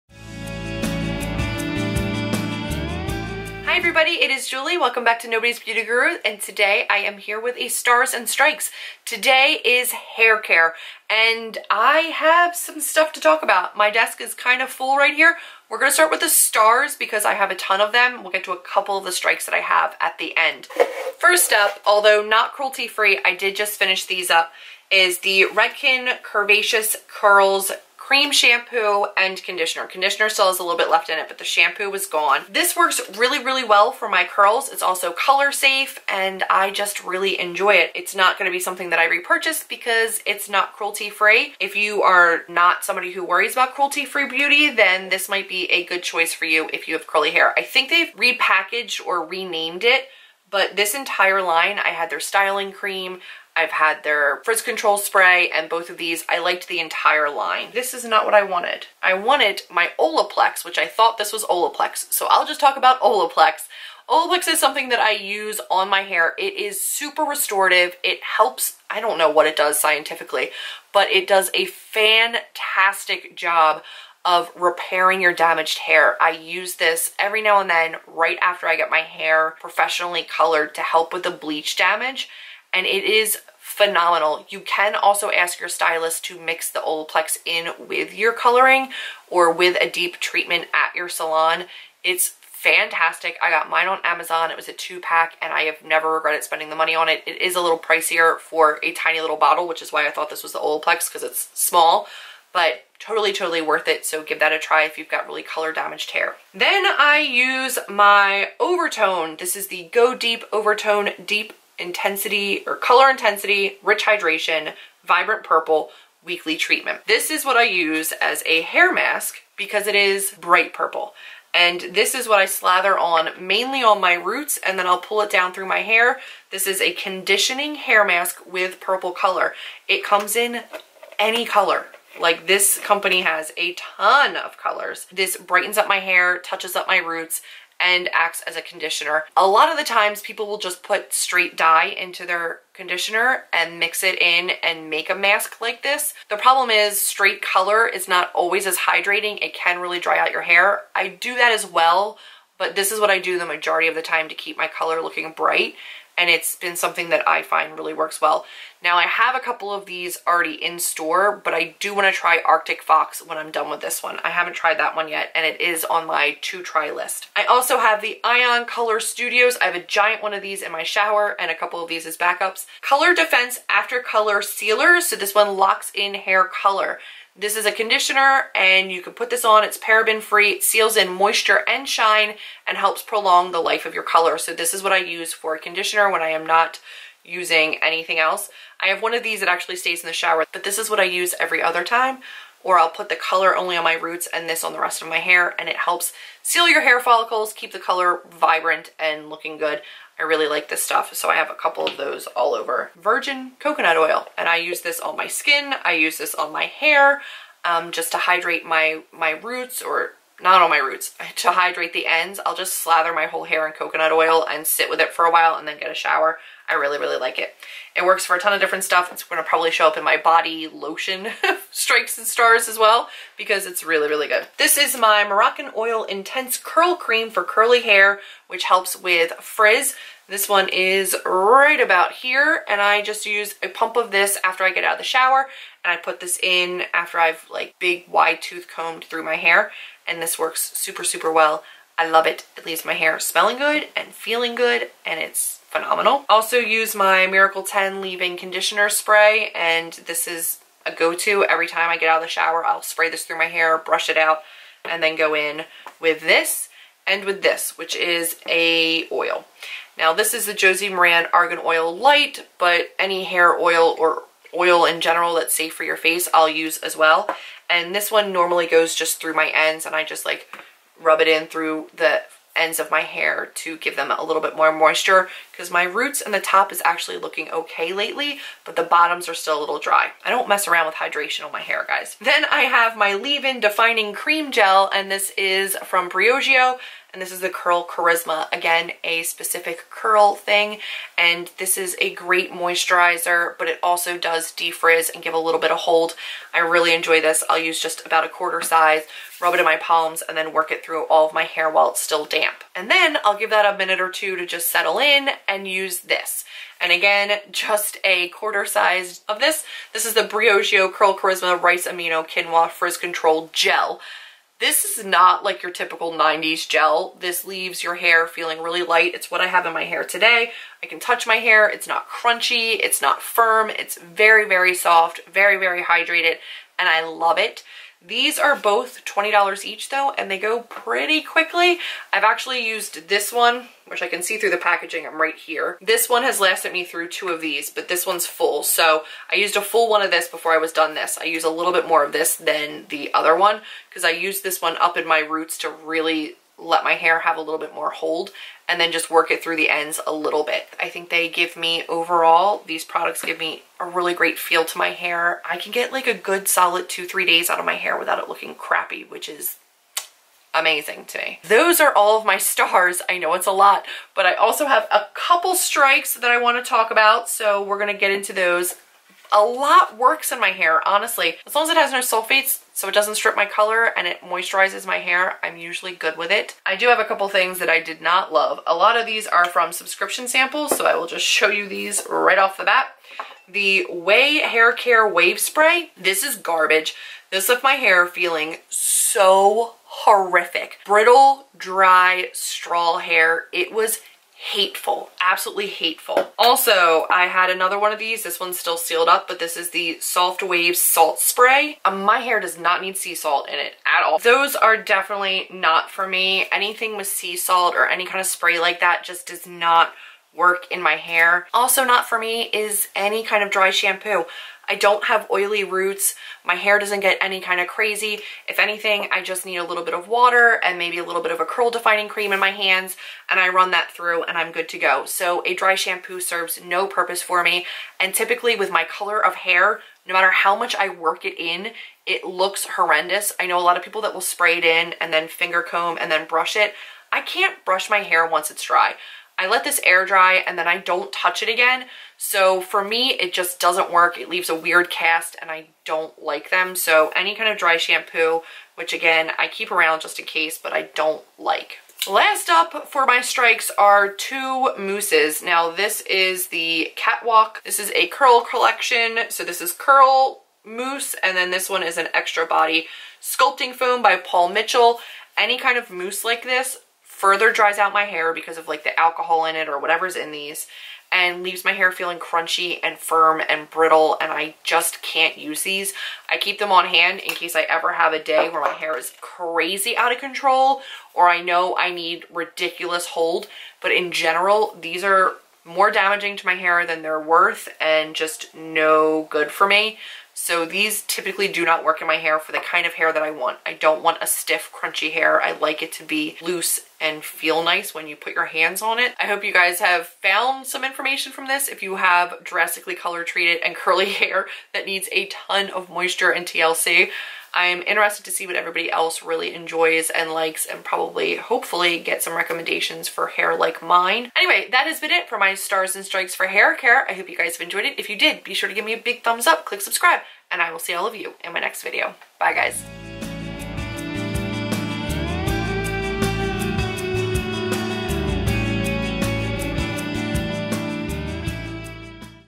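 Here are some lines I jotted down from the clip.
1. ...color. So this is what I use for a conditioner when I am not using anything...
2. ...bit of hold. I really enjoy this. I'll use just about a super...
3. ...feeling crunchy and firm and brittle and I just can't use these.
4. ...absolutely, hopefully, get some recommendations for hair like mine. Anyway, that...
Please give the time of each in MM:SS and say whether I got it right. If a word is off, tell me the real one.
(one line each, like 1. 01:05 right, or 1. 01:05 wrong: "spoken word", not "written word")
1. 03:04 right
2. 04:55 wrong: "quarter", not "super"
3. 07:51 right
4. 08:30 wrong: "probably", not "absolutely".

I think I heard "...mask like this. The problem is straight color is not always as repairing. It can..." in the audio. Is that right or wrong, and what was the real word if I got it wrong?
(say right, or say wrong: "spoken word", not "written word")
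wrong: "hydrating", not "repairing".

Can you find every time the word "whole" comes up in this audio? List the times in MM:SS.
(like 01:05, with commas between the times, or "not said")
03:33.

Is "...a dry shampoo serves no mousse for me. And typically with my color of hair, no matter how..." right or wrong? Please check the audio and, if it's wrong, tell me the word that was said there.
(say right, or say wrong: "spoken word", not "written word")
wrong: "purpose", not "mousse".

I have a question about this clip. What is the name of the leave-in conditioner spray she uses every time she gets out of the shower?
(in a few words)
Miracle 10.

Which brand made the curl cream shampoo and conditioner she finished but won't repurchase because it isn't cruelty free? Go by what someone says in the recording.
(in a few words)
Redken.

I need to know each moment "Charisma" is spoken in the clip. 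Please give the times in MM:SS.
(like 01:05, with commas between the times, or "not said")
04:47, 05:11.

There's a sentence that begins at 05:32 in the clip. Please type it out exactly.
I've actually used this one, which I can see through the packaging, I'm right here.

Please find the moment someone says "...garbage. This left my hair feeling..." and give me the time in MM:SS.
06:26.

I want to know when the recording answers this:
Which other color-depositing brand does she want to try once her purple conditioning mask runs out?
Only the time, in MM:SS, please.
02:42.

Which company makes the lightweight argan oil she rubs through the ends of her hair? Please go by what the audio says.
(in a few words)
Josie Maran.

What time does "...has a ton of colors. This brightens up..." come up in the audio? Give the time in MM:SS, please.
02:13.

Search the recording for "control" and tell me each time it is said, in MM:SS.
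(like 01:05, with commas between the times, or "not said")
00:54, 05:12, 08:00.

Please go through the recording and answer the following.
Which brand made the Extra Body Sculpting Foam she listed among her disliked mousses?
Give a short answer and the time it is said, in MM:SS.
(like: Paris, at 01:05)
Paul Mitchell, at 07:44.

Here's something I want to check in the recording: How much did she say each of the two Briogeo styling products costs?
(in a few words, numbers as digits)
$20.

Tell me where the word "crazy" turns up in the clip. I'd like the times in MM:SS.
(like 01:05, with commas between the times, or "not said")
06:57, 07:59.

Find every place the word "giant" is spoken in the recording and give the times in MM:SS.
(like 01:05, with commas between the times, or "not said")
02:49.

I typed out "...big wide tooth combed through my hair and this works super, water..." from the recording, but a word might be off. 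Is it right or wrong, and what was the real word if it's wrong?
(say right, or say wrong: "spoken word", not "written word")
wrong: "super", not "water".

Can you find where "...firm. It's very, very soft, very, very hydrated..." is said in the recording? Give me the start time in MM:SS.
05:23.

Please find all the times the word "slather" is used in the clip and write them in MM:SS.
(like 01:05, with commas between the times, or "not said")
02:02, 03:32.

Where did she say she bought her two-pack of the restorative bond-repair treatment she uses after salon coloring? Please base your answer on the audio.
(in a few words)
Amazon.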